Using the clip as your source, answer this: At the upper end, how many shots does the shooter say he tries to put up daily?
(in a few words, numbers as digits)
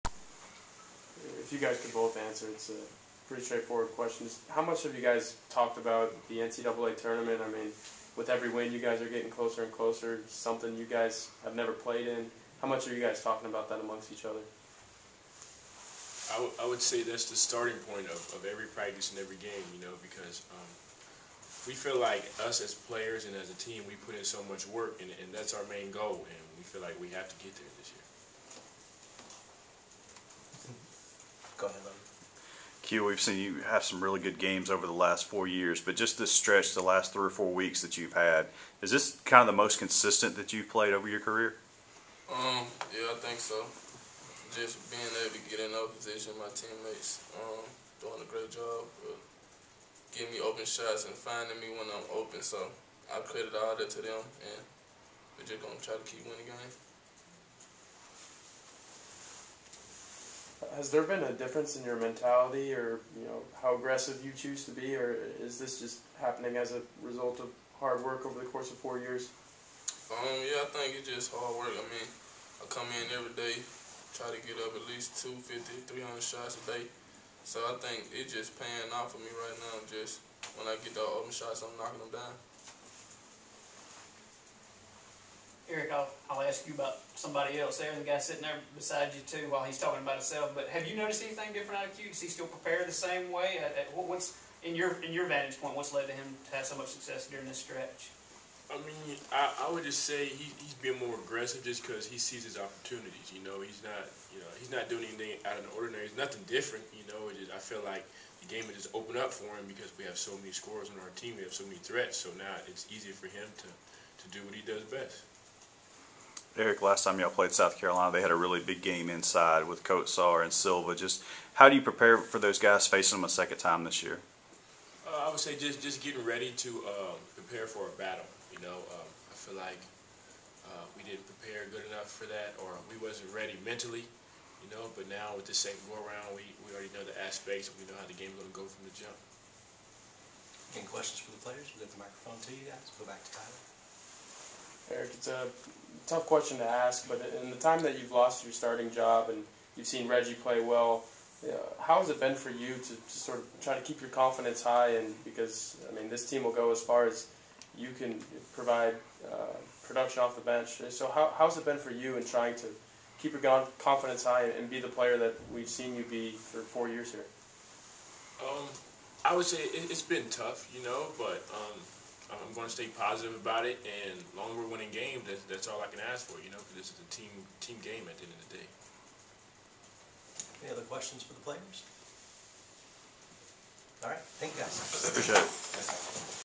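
300.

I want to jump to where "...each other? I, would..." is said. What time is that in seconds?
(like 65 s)
14 s.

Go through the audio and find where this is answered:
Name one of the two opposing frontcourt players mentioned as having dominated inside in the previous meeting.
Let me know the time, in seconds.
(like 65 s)
119 s.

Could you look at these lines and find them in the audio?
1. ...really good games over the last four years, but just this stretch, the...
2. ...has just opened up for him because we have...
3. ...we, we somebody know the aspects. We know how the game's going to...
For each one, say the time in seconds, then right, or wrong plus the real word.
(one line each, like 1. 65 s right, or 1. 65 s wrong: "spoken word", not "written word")
1. 34 s right
2. 108 s right
3. 136 s wrong: "already", not "somebody".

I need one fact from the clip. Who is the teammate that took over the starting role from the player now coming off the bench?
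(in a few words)
Reggie.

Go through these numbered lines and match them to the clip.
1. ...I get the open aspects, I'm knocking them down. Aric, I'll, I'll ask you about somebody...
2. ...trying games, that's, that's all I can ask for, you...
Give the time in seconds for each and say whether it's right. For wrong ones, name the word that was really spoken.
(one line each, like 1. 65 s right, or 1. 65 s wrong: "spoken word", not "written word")
1. 80 s wrong: "shots", not "aspects"
2. 174 s wrong: "winning", not "trying".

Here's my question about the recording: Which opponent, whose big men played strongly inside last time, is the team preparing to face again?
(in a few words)
South Carolina.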